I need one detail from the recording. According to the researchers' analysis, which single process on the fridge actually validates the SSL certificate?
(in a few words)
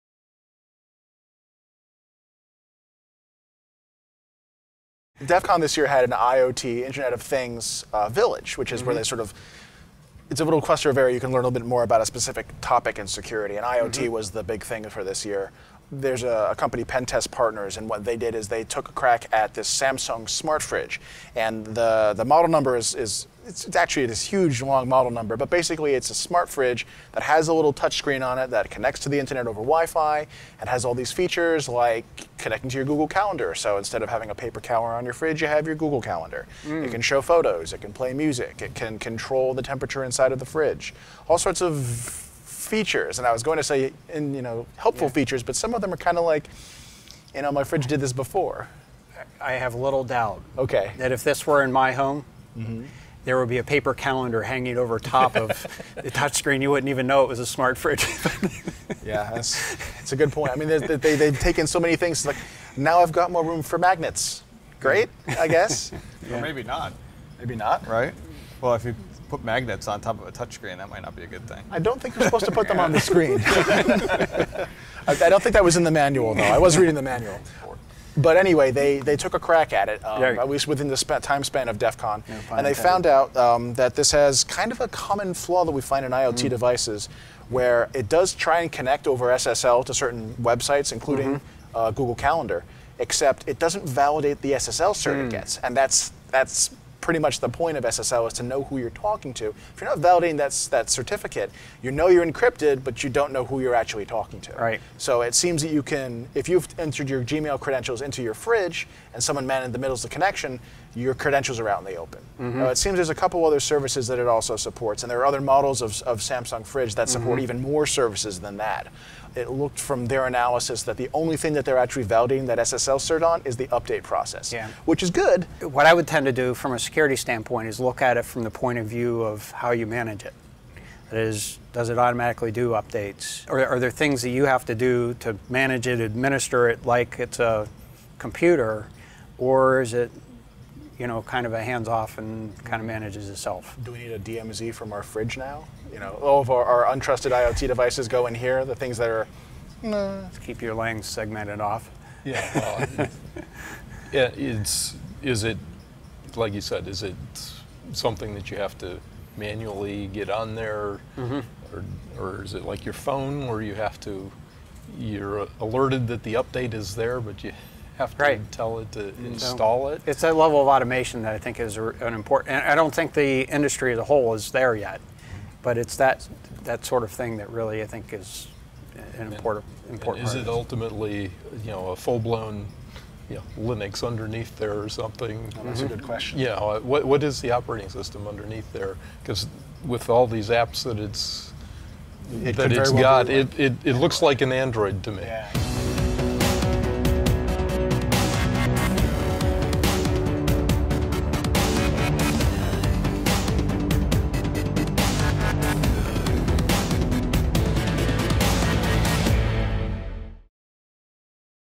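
The update process.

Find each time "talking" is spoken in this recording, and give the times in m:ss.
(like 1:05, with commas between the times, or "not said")
1:38, 1:44.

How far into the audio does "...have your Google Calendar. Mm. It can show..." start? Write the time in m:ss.
0:35.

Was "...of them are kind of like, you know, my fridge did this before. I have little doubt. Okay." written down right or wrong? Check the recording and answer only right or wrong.
right.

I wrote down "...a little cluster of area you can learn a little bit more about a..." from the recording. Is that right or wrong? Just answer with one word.
right.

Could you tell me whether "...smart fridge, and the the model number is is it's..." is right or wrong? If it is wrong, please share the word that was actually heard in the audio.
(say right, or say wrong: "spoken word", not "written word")
right.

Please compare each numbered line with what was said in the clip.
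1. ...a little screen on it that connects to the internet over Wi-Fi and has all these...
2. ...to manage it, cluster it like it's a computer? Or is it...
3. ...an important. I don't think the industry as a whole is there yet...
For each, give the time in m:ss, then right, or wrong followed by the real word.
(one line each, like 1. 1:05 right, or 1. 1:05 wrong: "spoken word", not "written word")
1. 0:27 wrong: "touchscreen", not "screen"
2. 2:15 wrong: "administer", not "cluster"
3. 2:51 right.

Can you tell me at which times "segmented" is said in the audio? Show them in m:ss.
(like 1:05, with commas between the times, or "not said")
2:31.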